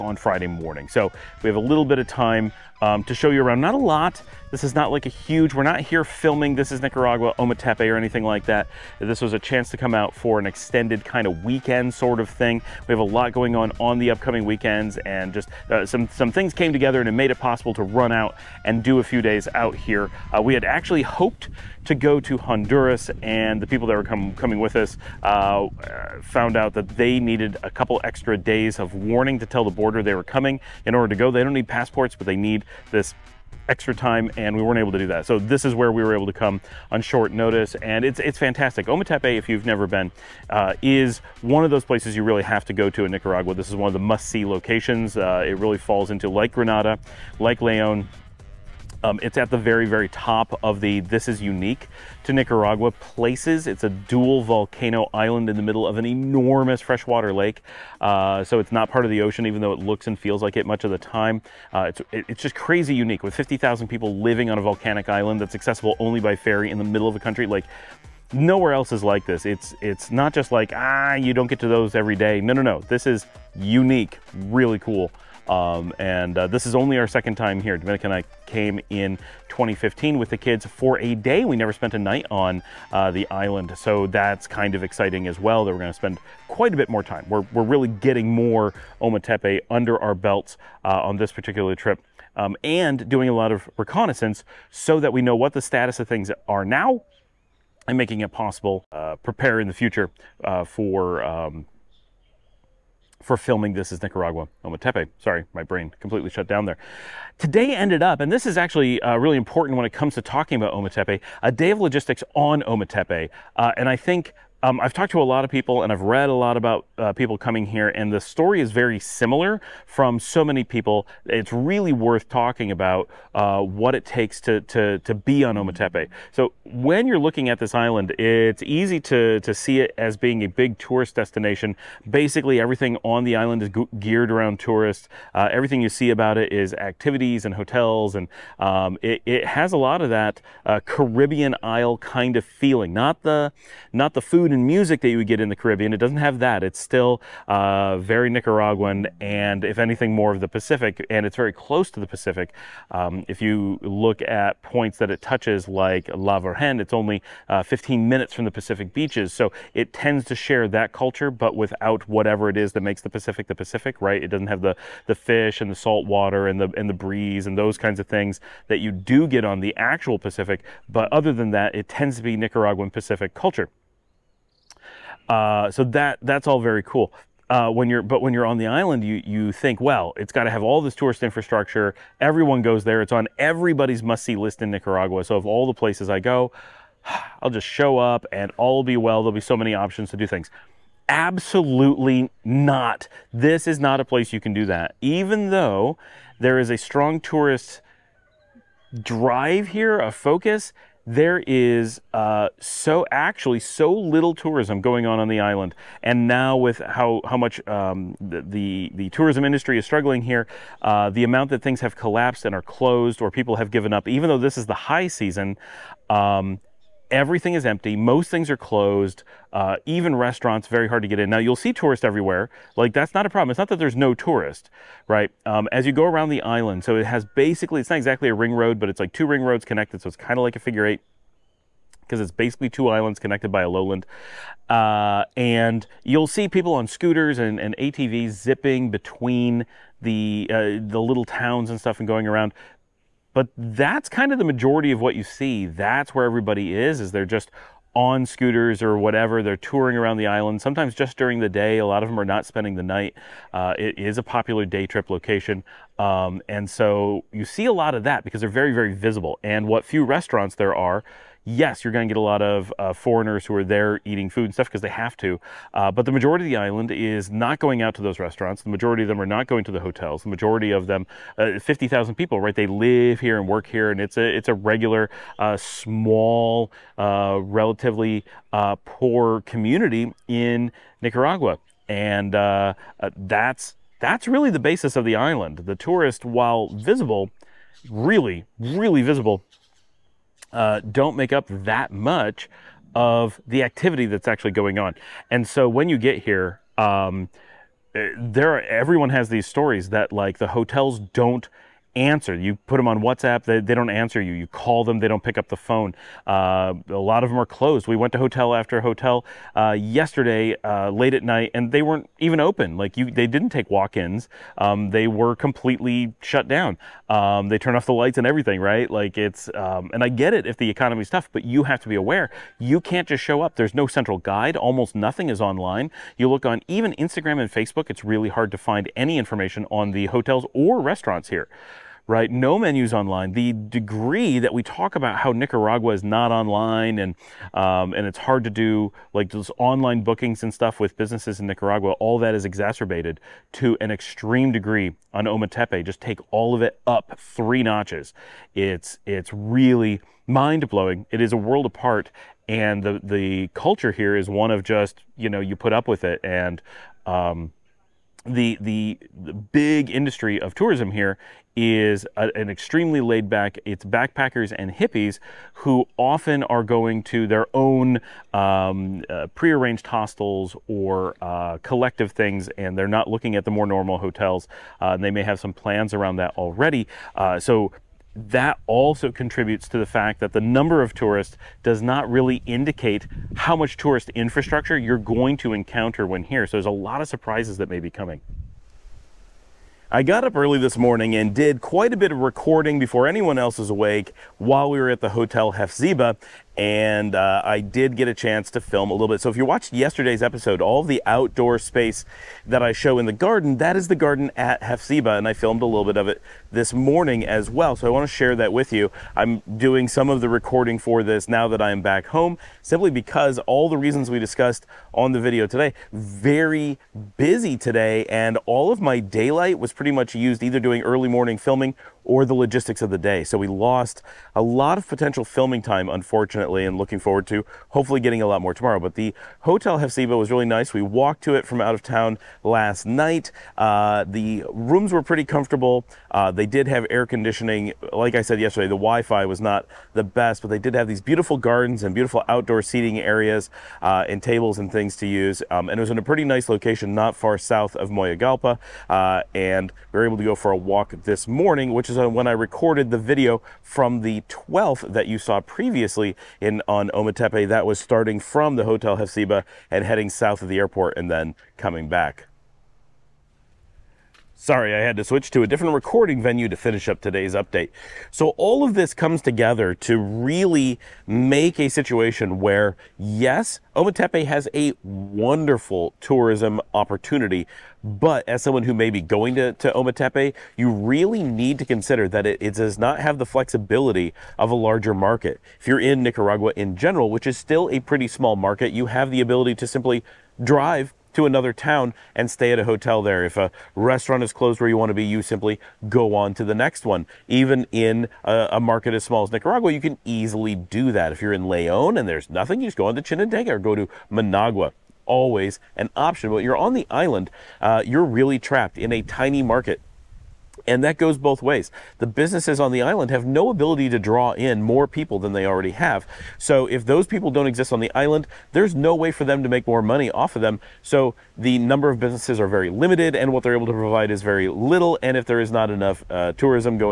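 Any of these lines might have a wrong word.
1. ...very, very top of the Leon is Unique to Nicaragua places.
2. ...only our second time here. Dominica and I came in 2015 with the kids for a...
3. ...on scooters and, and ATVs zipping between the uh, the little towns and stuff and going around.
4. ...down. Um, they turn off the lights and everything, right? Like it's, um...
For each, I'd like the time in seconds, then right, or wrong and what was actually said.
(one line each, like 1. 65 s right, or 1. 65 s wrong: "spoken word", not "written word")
1. 49 s wrong: "This", not "Leon"
2. 76 s right
3. 236 s right
4. 316 s right.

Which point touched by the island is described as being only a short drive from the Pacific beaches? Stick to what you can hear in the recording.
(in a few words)
La Virgen.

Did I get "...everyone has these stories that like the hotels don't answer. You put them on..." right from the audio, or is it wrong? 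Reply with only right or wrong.
right.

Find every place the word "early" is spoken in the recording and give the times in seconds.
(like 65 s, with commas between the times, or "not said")
390 s, 420 s.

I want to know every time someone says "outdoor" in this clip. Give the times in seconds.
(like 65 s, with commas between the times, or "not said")
401 s, 442 s.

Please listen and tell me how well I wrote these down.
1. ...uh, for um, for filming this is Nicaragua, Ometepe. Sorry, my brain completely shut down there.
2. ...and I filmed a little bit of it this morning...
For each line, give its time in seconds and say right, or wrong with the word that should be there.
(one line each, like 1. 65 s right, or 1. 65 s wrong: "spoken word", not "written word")
1. 100 s right
2. 405 s right.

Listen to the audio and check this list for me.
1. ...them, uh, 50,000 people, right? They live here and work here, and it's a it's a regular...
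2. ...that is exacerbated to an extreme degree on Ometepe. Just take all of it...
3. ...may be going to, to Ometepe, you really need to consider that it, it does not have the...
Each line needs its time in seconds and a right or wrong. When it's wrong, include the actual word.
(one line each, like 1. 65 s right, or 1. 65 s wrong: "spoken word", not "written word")
1. 270 s right
2. 342 s right
3. 478 s right.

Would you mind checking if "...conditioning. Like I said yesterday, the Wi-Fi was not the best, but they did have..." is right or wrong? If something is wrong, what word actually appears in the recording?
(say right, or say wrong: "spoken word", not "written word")
right.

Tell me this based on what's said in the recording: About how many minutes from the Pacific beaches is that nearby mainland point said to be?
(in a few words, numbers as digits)
15.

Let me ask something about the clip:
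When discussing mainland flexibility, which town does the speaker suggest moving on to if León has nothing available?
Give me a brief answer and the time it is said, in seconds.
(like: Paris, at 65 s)
Chinandega, at 503 s.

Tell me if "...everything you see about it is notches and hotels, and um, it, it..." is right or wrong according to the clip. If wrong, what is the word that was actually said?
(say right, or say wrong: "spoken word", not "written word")
wrong: "activities", not "notches".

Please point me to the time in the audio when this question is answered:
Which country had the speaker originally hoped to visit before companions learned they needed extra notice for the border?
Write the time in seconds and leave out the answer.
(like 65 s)
22 s.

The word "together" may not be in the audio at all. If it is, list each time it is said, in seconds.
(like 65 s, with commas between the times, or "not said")
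16 s, 469 s.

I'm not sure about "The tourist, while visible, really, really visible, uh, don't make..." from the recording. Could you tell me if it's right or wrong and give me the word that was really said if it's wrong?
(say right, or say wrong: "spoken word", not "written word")
right.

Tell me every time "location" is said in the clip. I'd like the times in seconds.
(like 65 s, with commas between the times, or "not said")
44 s, 255 s, 446 s.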